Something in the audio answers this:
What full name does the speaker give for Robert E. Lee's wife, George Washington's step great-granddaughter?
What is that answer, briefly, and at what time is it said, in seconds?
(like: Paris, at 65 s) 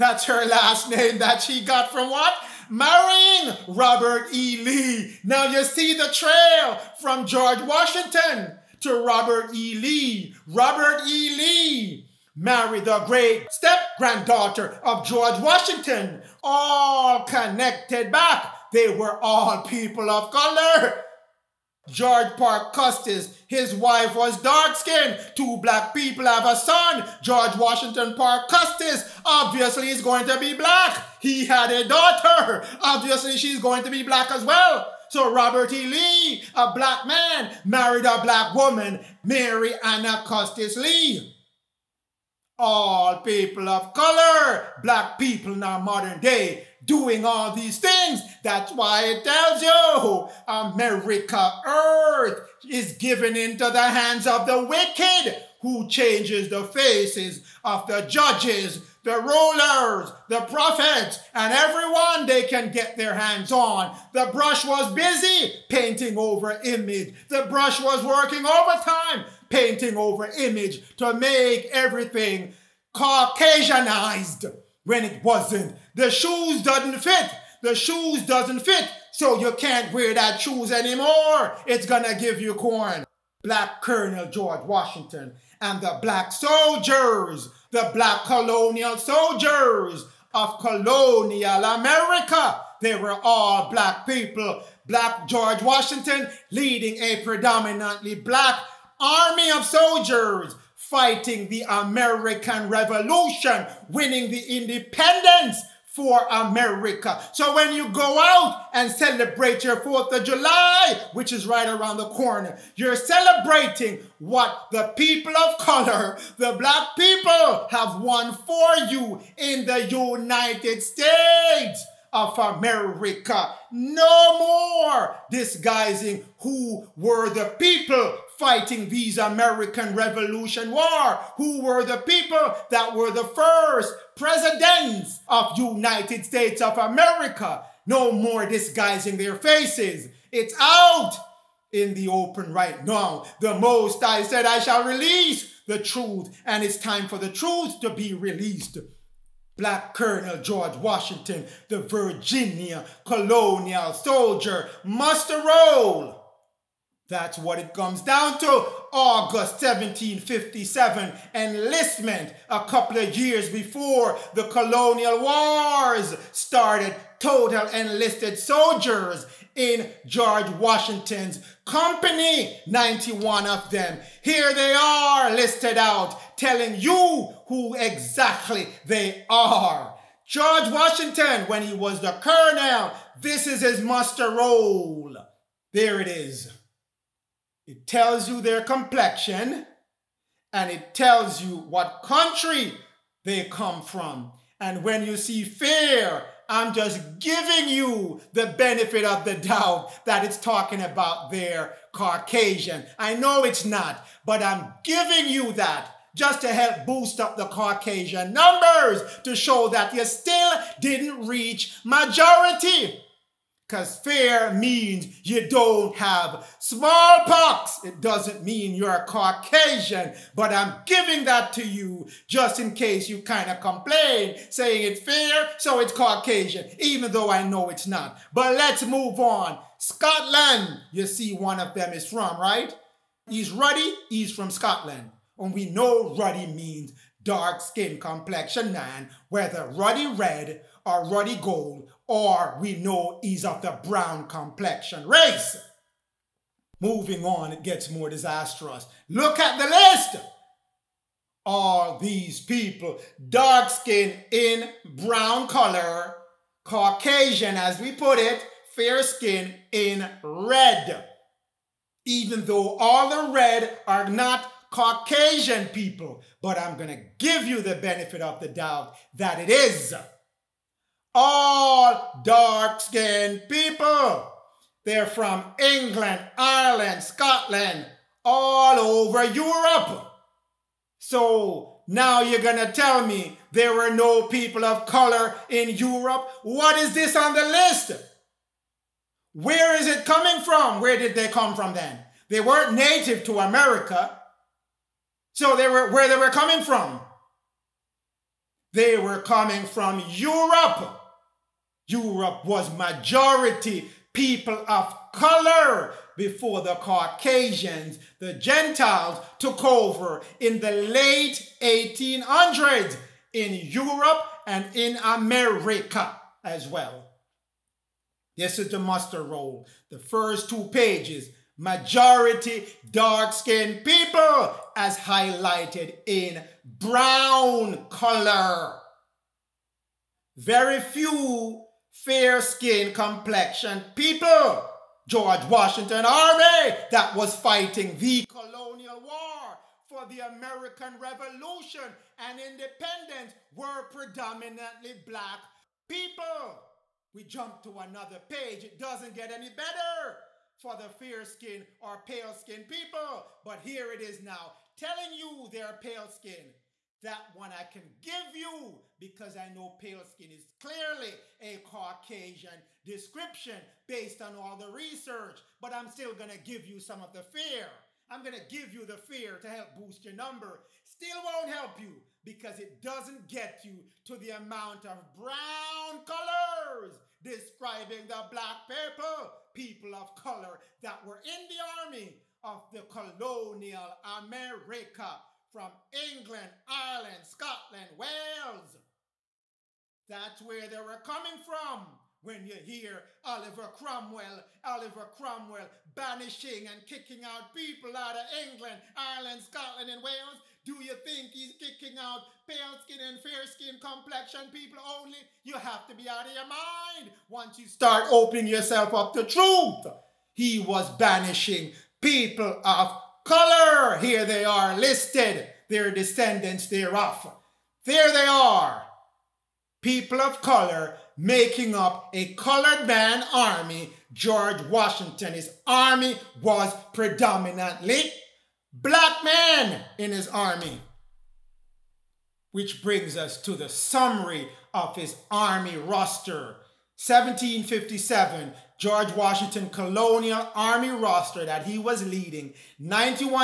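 Mary Anna Custis Lee, at 39 s.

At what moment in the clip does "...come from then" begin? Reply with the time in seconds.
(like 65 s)
291 s.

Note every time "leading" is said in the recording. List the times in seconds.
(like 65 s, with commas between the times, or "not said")
96 s, 442 s.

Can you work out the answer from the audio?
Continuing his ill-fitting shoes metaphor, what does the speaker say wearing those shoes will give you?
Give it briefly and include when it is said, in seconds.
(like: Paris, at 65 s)
corn, at 82 s.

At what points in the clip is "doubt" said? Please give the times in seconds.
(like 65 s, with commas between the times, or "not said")
199 s, 268 s.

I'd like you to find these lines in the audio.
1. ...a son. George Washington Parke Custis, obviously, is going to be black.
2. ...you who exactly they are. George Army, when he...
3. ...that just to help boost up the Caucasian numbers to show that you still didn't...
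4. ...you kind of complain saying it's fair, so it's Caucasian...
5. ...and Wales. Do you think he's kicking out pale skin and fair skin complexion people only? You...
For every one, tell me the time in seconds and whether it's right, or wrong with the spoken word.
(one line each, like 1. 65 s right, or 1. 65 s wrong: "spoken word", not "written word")
1. 26 s right
2. 176 s wrong: "Washington", not "Army"
3. 205 s right
4. 223 s right
5. 399 s right.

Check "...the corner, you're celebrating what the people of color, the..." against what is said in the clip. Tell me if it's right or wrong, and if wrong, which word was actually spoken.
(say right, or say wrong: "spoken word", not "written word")
right.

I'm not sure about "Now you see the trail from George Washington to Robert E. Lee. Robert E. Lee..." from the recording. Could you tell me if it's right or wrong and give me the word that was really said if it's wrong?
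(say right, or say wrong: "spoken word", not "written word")
right.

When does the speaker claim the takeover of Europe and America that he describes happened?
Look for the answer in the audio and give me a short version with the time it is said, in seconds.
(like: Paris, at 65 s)
late 1800s, at 310 s.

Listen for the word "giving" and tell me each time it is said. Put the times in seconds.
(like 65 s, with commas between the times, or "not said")
197 s, 204 s, 220 s.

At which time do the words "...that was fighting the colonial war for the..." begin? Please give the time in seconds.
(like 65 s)
336 s.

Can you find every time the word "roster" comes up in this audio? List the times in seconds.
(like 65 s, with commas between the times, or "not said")
435 s, 440 s.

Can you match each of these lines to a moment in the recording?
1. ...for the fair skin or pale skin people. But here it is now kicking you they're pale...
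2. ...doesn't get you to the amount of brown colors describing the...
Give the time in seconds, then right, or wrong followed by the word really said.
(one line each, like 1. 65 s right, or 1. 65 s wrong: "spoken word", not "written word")
1. 350 s wrong: "telling", not "kicking"
2. 372 s right.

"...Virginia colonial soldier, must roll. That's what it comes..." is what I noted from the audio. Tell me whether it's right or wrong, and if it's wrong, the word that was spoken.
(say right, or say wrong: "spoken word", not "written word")
right.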